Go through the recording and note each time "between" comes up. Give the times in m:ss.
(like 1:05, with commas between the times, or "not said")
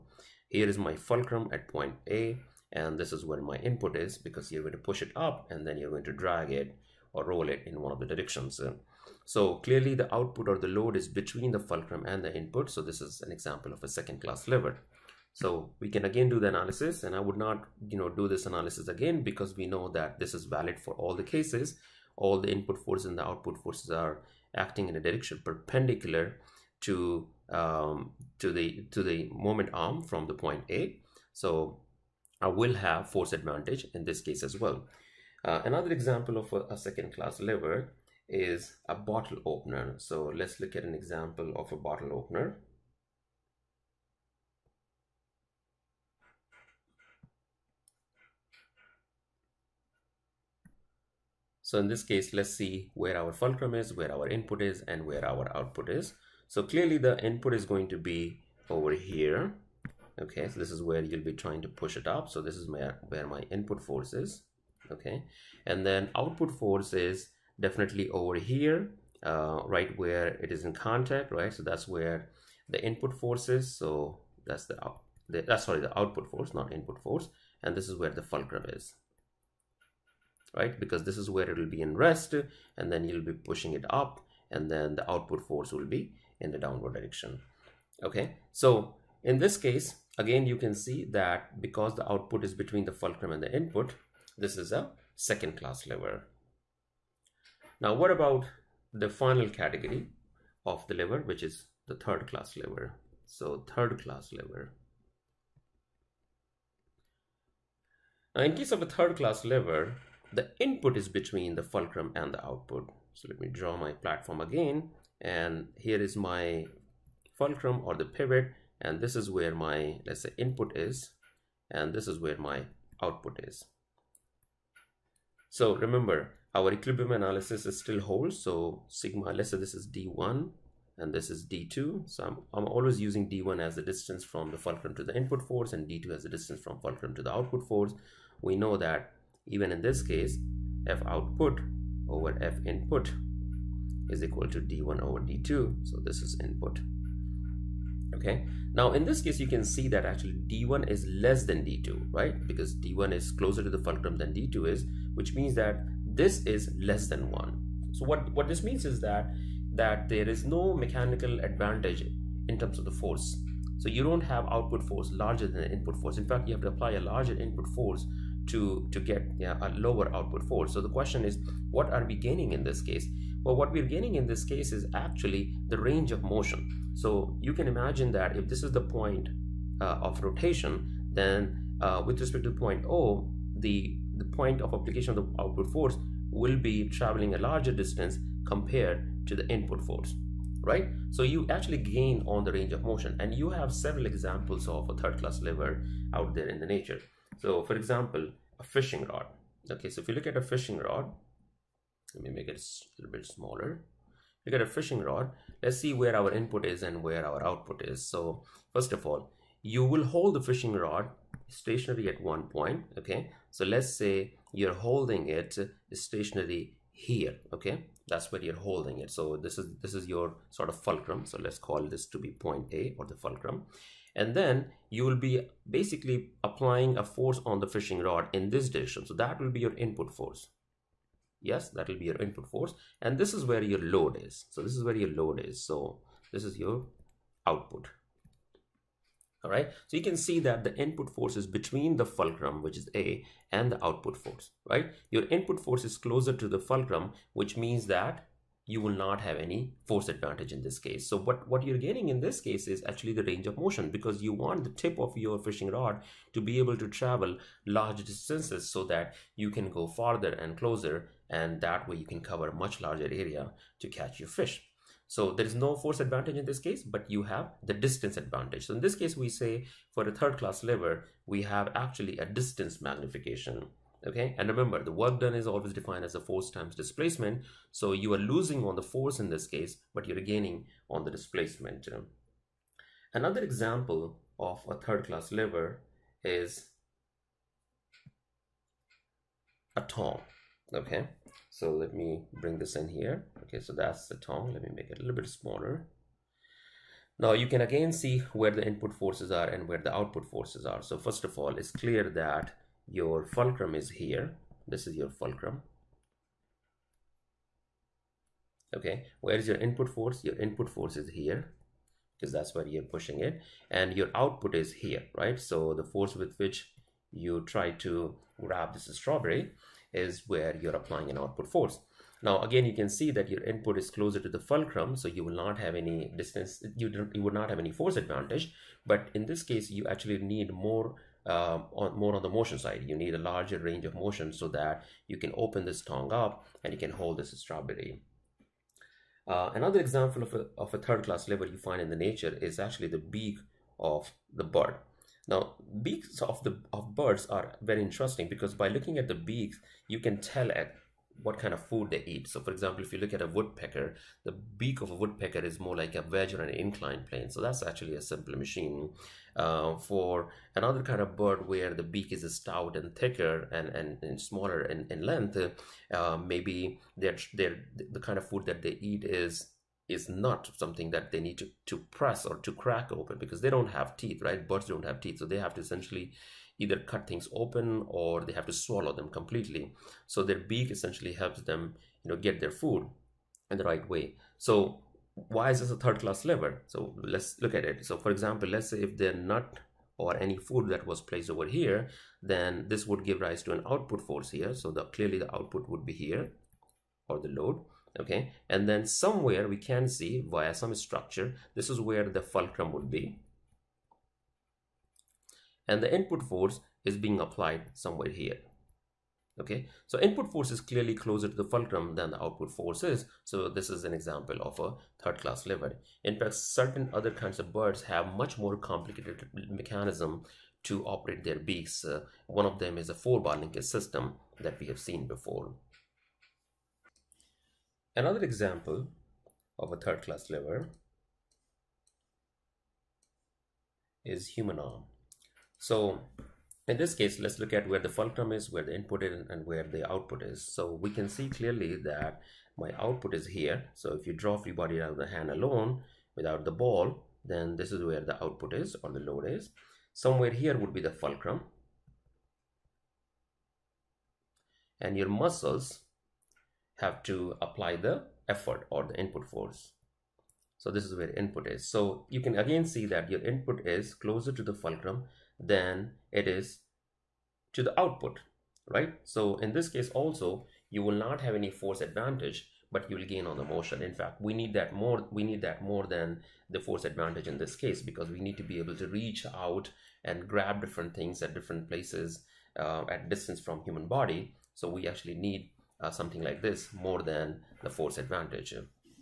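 0:11, 1:32, 1:51, 4:01.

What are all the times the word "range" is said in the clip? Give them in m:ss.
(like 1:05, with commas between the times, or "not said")
2:55, 3:12, 4:13, 5:33.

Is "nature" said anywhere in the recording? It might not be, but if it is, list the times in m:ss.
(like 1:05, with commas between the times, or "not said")
3:16, 5:41.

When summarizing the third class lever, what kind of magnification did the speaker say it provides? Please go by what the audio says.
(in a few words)
Distance magnification.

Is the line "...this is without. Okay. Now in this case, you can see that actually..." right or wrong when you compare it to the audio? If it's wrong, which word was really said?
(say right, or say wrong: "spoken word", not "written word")
wrong: "input", not "without".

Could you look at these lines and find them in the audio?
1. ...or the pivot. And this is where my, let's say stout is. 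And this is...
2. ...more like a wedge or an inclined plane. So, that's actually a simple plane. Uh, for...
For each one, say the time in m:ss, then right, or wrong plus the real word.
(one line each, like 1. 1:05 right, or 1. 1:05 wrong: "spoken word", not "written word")
1. 1:57 wrong: "input", not "stout"
2. 5:55 wrong: "machine", not "plane".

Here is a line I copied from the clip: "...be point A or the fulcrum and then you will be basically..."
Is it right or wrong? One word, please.
right.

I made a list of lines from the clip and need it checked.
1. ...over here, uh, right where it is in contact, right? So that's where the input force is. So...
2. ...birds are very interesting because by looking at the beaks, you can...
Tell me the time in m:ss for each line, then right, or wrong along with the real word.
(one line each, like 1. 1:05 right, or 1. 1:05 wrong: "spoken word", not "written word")
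1. 1:08 right
2. 5:46 right.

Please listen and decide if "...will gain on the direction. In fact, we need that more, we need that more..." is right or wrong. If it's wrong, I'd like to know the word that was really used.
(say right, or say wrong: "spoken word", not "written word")
wrong: "motion", not "direction".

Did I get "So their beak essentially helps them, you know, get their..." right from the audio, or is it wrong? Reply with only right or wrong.
right.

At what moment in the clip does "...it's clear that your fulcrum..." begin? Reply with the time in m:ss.
5:01.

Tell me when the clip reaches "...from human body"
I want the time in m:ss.
8:03.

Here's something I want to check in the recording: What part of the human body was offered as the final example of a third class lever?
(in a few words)
Human arm.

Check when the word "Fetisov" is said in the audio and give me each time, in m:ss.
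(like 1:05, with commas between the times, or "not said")
not said.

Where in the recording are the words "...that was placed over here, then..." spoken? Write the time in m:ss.
6:30.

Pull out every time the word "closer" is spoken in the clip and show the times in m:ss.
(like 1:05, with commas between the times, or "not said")
2:33, 4:05, 4:20, 5:23, 6:50, 7:43.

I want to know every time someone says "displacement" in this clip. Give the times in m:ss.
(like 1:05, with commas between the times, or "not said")
4:36, 4:41.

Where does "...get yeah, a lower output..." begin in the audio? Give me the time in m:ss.
2:48.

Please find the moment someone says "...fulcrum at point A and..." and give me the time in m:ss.
0:00.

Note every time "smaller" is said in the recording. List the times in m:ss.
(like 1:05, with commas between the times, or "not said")
3:23, 4:55, 6:04.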